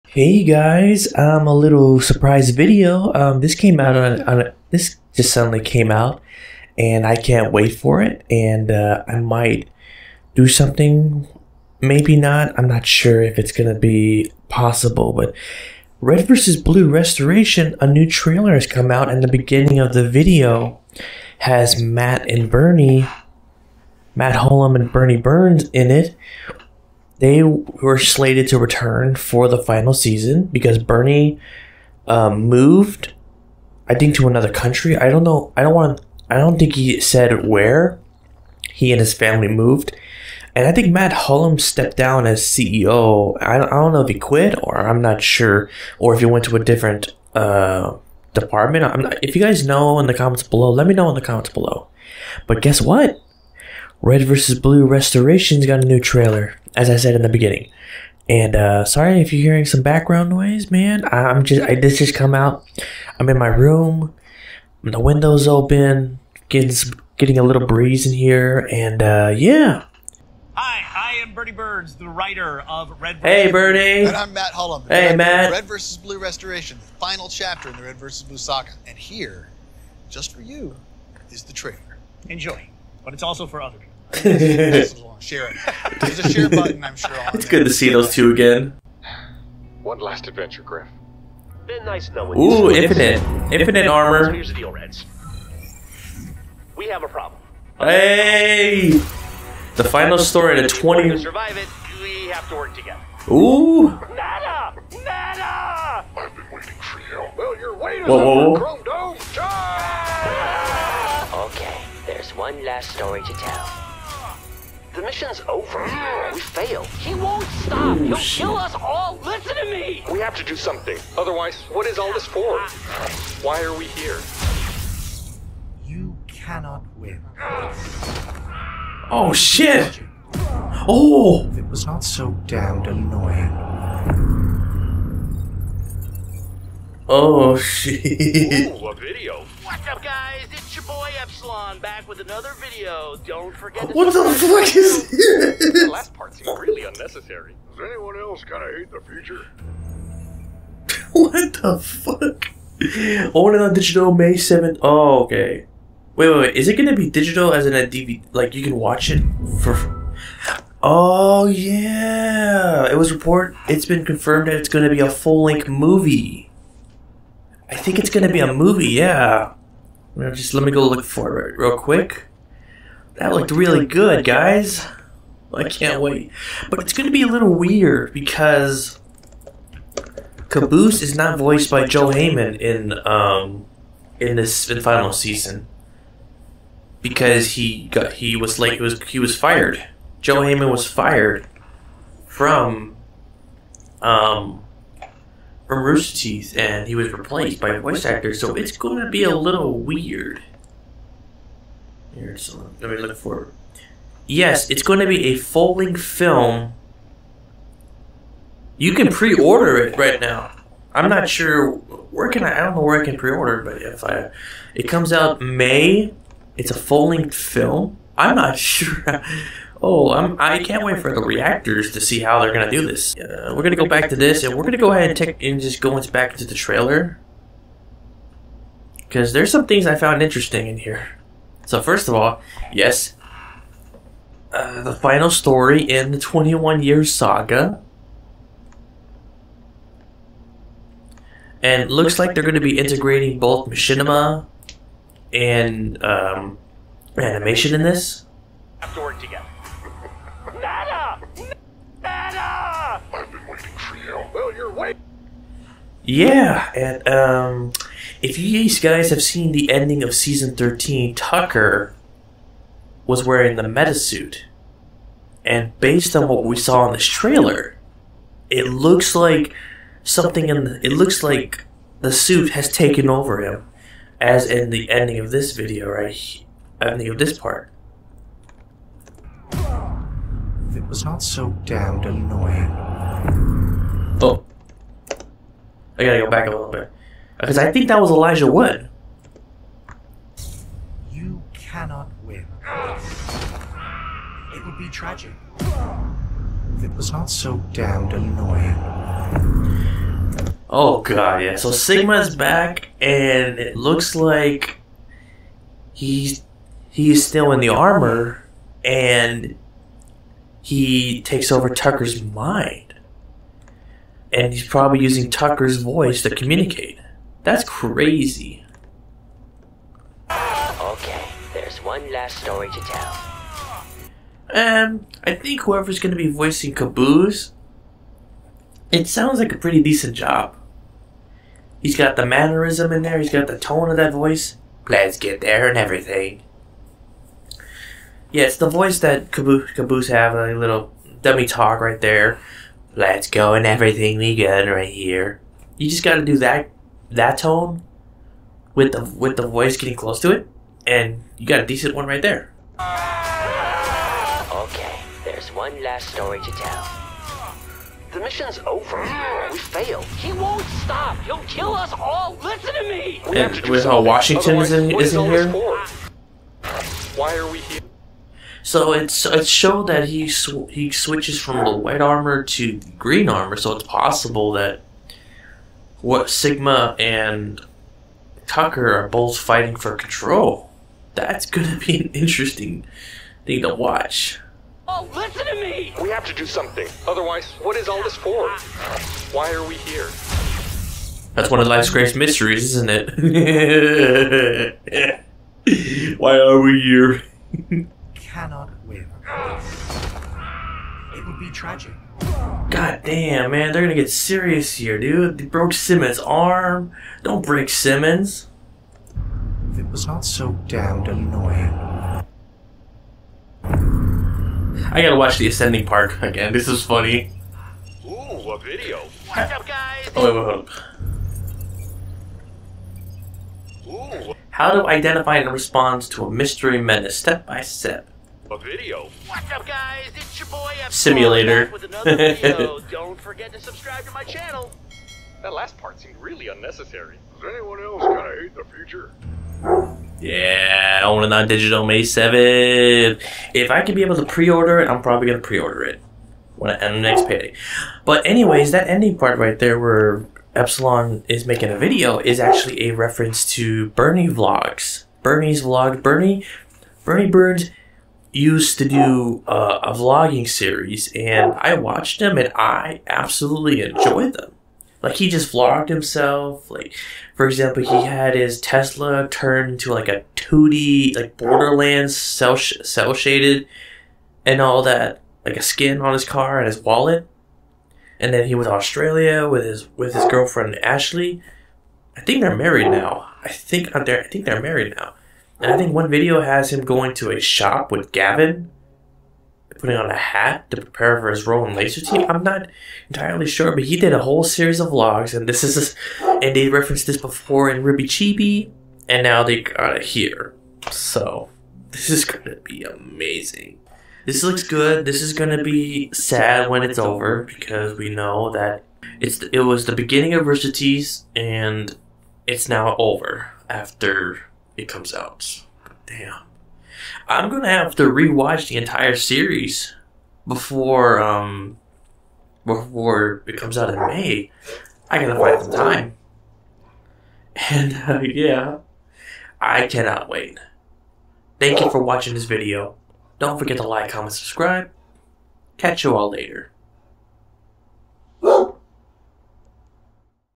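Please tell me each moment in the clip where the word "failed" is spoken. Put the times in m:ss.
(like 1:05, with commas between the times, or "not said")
1:56, 5:59.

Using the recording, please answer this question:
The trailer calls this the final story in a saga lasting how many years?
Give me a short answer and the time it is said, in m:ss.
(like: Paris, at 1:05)
21, at 3:56.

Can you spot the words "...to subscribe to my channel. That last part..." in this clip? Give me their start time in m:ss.
7:13.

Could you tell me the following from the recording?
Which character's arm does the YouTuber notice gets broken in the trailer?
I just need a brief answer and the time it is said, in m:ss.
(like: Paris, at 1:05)
Simmons, at 6:45.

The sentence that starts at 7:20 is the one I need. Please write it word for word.
Yeah, on and on digital May 7th.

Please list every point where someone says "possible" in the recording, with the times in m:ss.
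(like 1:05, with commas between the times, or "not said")
0:14, 6:13.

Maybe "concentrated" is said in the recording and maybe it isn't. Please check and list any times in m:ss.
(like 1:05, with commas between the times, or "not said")
not said.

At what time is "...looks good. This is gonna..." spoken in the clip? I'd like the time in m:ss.
8:24.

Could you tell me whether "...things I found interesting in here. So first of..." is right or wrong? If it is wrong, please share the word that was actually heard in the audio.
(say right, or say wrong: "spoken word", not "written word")
right.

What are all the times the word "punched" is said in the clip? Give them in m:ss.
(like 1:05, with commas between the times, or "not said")
not said.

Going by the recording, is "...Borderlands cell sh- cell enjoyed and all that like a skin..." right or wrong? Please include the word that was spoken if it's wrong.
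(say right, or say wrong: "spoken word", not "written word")
wrong: "shaded", not "enjoyed".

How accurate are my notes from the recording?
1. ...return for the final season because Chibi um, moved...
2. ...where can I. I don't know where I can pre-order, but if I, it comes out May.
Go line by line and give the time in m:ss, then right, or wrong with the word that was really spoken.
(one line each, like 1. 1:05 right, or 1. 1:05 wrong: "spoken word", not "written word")
1. 0:28 wrong: "Bernie", not "Chibi"
2. 3:31 right.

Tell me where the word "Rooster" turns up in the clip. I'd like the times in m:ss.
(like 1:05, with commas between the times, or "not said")
3:15, 8:30.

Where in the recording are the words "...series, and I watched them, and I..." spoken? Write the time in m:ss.
7:40.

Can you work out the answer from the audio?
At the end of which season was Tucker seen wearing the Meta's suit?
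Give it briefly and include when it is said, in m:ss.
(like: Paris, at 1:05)
Season 13, at 4:20.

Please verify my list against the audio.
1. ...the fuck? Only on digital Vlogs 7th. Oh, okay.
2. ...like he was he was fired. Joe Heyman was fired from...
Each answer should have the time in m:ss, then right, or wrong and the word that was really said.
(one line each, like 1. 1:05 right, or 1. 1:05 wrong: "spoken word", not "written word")
1. 2:31 wrong: "May", not "Vlogs"
2. 3:08 right.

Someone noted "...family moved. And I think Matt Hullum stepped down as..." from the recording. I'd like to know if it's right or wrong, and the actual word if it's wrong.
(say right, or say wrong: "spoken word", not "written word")
right.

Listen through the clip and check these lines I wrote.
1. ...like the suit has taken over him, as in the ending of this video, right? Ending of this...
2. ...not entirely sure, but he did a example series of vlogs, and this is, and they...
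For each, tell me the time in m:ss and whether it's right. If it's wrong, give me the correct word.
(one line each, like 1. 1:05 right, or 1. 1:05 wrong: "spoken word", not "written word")
1. 4:31 right
2. 8:12 wrong: "whole", not "example".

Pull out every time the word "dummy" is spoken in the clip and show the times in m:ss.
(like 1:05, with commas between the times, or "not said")
5:41.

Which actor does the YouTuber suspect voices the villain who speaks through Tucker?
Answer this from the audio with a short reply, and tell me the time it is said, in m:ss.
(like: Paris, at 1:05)
Elijah Wood, at 4:48.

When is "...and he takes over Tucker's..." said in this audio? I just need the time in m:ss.
5:08.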